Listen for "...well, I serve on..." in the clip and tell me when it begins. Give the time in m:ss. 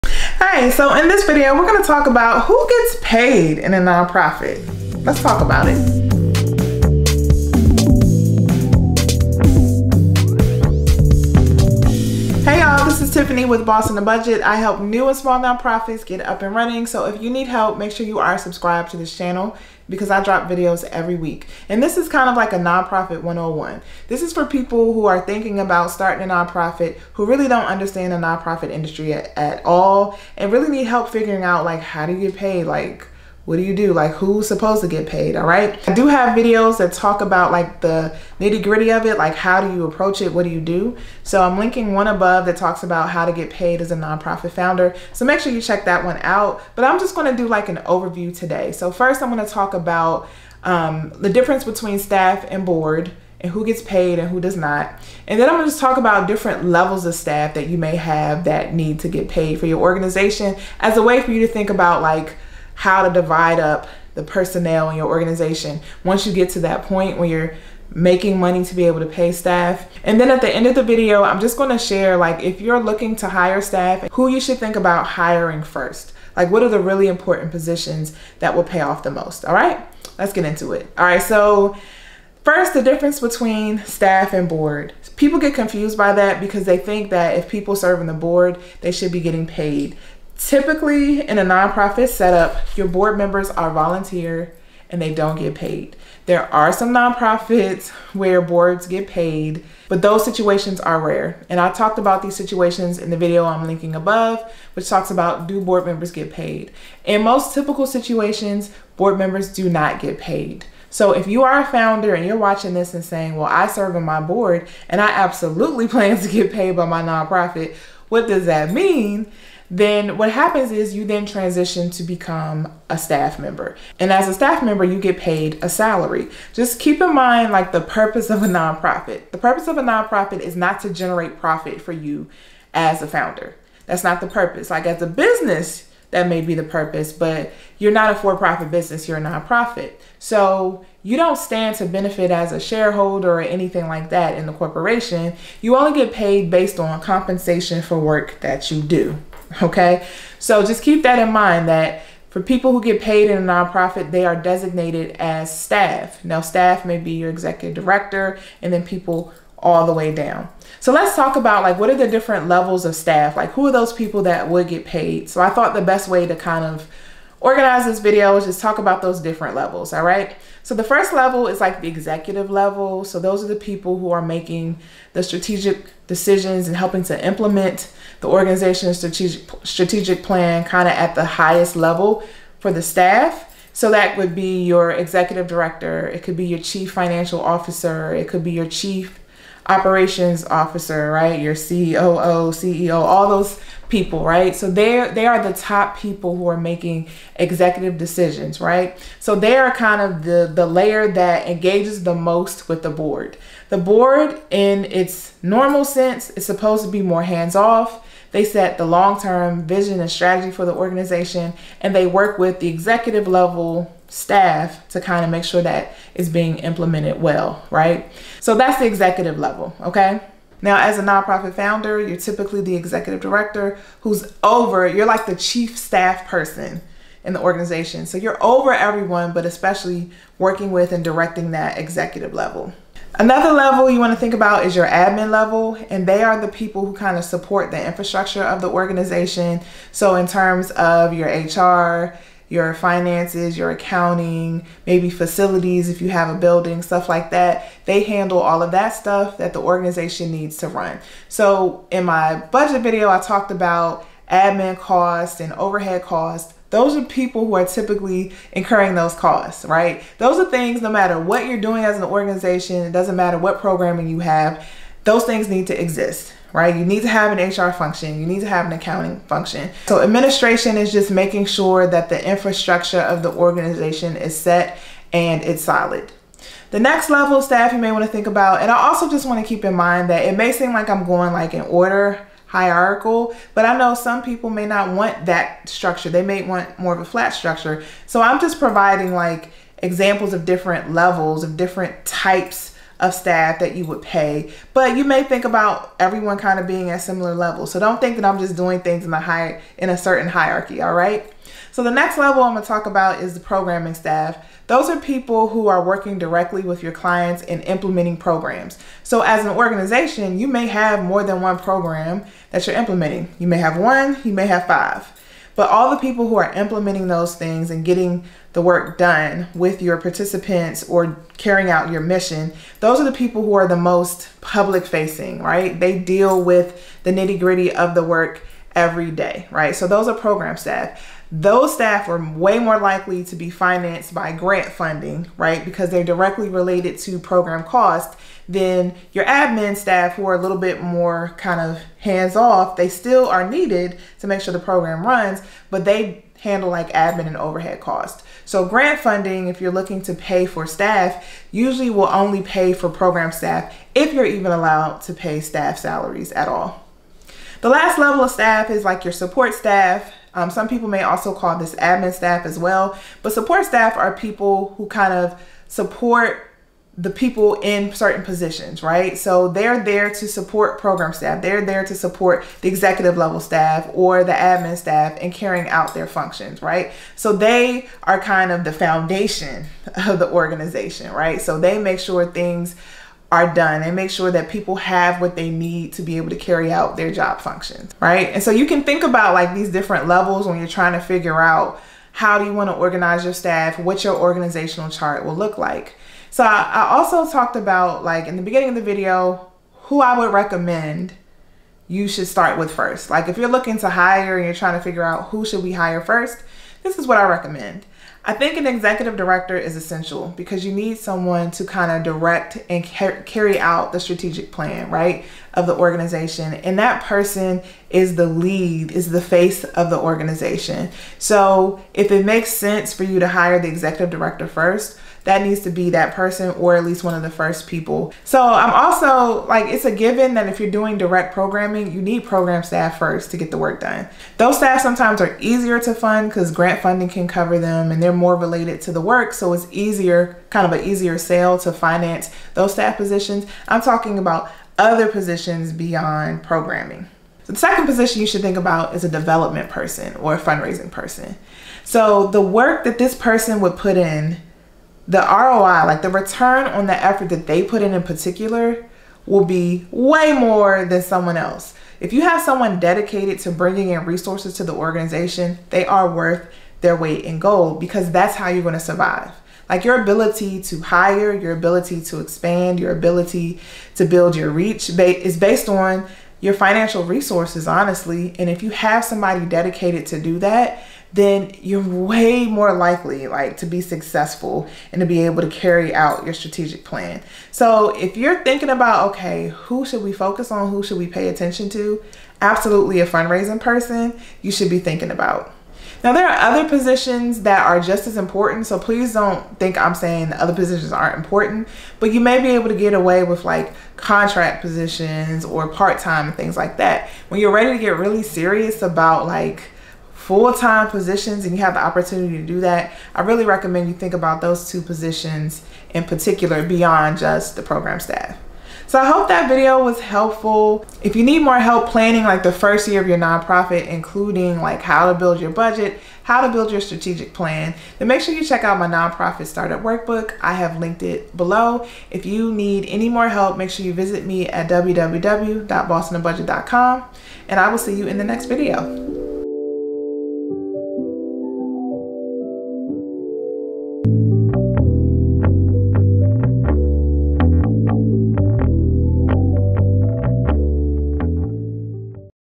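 1:53.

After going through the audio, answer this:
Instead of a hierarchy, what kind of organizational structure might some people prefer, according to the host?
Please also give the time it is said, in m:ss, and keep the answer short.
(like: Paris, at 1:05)
Flat structure, at 4:47.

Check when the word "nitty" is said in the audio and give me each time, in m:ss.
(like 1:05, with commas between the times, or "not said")
0:38, 5:27.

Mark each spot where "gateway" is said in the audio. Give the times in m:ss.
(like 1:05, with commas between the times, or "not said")
not said.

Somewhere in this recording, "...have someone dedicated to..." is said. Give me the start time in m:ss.
7:42.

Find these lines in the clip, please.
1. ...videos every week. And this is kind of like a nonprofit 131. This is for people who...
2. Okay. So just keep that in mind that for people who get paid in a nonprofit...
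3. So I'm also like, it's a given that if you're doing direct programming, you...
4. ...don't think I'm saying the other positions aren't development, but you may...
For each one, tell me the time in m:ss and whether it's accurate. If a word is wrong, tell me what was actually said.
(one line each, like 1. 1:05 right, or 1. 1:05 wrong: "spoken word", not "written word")
1. 0:20 wrong: "101", not "131"
2. 2:29 right
3. 7:08 right
4. 8:19 wrong: "important", not "development".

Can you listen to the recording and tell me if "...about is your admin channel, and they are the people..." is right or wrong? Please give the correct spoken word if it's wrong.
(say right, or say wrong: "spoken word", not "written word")
wrong: "level", not "channel".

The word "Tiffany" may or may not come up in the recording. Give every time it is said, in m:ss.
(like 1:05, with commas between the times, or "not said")
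0:13.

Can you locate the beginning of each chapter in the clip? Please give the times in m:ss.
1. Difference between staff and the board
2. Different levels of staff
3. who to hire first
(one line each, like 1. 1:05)
1. 1:23
2. 2:42
3. 6:39.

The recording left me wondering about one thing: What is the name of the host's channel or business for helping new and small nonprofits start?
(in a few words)
Boss on the Budget.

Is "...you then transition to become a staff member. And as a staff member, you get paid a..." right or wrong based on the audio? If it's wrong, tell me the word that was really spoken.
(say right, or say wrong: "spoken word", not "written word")
right.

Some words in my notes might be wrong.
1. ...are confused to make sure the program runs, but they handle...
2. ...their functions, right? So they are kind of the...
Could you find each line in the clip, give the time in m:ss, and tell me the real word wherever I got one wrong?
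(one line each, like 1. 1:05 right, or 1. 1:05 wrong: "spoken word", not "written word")
1. 5:43 wrong: "needed", not "confused"
2. 6:15 right.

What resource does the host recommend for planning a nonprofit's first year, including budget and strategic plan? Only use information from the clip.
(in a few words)
Nonprofit startup workbook.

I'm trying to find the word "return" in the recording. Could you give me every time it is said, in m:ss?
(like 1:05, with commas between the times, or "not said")
7:36.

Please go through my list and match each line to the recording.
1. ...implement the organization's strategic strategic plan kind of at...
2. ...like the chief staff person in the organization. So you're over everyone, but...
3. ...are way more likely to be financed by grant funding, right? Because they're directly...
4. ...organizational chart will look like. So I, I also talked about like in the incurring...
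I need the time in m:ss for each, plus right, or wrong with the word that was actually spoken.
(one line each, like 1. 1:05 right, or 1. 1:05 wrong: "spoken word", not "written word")
1. 2:57 right
2. 3:45 right
3. 5:32 right
4. 6:34 wrong: "beginning", not "incurring".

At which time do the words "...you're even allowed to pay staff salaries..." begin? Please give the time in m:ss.
5:54.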